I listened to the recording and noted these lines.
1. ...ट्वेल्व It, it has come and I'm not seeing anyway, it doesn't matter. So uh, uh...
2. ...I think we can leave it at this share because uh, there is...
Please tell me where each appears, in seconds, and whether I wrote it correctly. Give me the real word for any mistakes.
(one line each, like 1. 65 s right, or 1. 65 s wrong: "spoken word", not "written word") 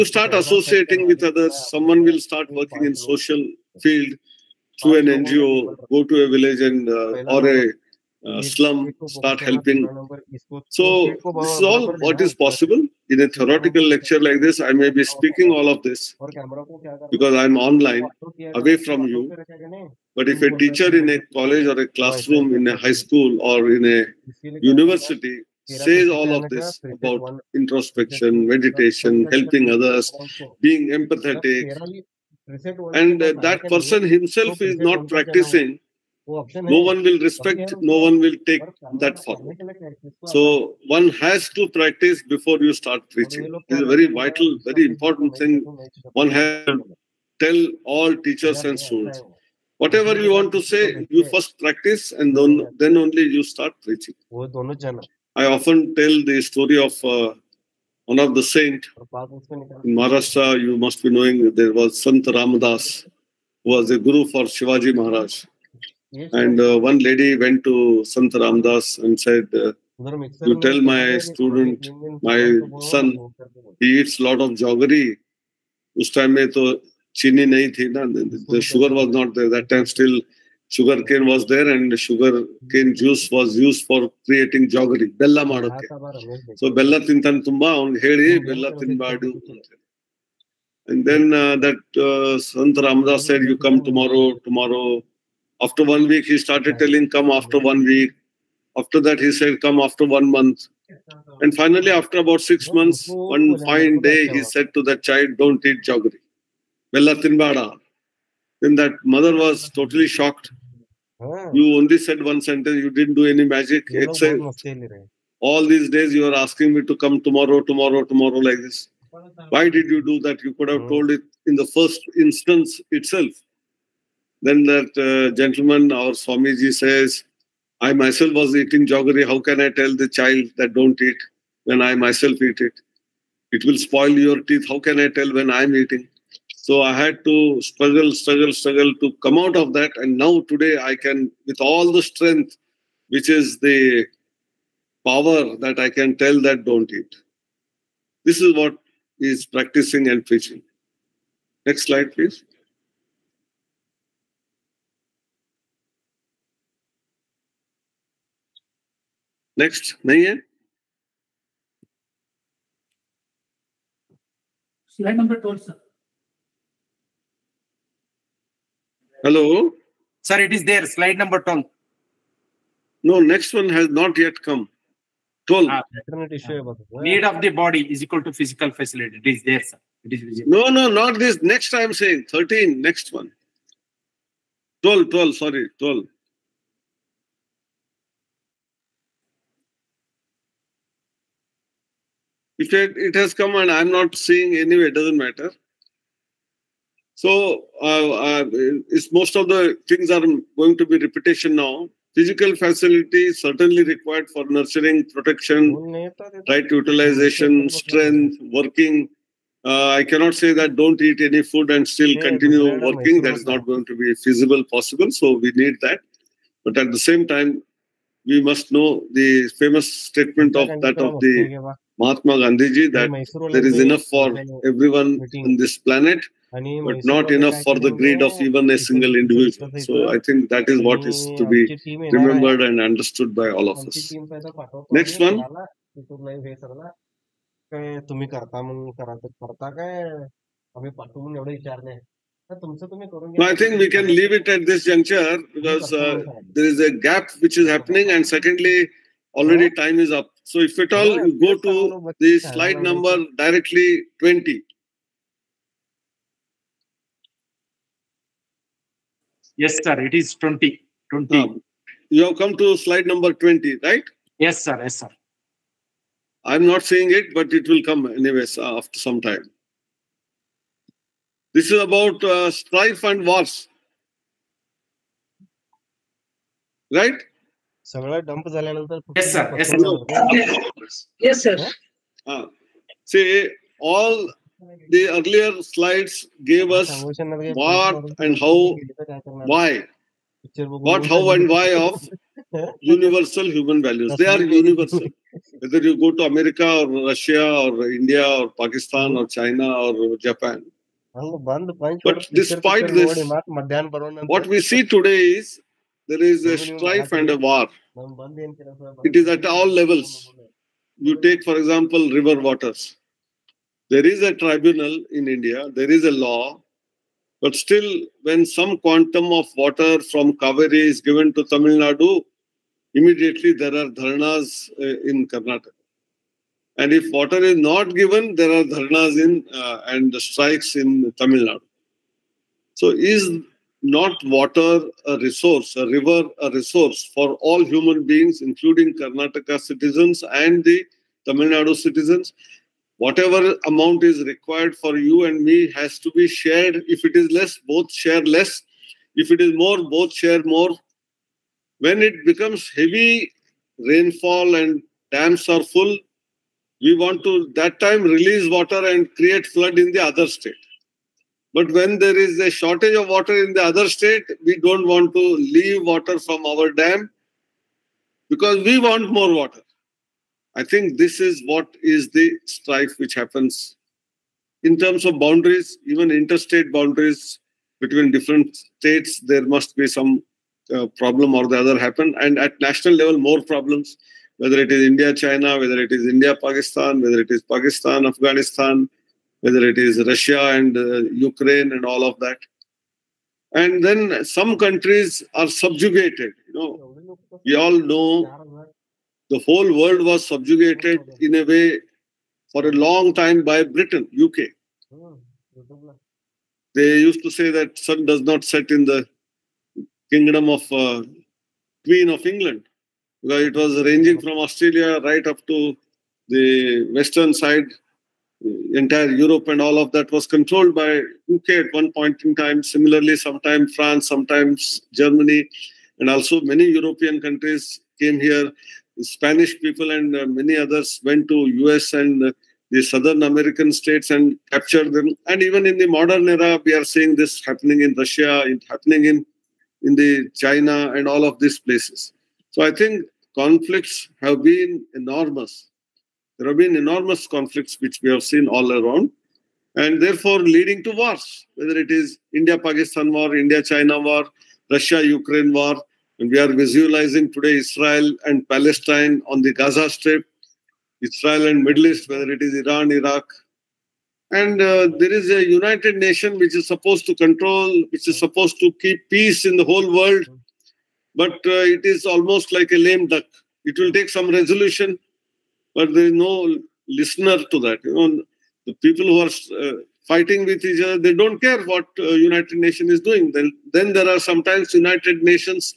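1. 185 s right
2. 243 s wrong: "juncture", not "share".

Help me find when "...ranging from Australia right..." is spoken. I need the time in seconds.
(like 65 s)
413 s.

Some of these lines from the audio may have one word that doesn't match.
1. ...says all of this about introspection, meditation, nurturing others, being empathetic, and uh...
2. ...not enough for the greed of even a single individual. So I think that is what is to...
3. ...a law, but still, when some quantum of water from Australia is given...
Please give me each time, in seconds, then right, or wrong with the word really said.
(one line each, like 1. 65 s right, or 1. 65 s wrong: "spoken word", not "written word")
1. 25 s wrong: "helping", not "nurturing"
2. 227 s right
3. 316 s wrong: "Kaveri", not "Australia".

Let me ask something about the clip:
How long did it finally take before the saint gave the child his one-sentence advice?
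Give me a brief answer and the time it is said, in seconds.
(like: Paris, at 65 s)
About six months, at 102 s.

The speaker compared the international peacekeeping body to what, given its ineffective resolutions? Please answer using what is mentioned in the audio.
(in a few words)
A lame duck.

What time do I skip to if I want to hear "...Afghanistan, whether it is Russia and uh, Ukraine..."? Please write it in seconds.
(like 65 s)
388 s.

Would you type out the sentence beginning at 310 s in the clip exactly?
You take, for example, river waters.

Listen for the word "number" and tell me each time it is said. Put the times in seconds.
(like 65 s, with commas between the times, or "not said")
252 s, 263 s.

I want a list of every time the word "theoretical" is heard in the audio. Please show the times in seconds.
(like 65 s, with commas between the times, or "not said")
13 s.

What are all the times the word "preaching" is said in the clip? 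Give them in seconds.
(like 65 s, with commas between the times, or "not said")
43 s, 53 s, 150 s.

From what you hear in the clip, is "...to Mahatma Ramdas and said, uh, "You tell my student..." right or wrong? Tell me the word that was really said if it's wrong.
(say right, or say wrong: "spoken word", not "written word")
wrong: "Sant", not "Mahatma".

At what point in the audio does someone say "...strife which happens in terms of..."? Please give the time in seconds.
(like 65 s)
372 s.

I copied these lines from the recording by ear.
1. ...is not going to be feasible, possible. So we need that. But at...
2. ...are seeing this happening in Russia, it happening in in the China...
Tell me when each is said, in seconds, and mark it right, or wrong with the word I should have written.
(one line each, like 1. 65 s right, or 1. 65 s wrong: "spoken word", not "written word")
1. 213 s right
2. 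436 s right.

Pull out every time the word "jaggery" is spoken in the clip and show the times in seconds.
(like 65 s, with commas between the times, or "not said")
74 s, 84 s, 105 s, 128 s.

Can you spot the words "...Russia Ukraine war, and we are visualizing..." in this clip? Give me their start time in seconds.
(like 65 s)
454 s.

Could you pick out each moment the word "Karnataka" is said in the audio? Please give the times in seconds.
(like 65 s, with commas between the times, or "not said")
325 s, 338 s.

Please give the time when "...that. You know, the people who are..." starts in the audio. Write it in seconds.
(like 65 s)
477 s.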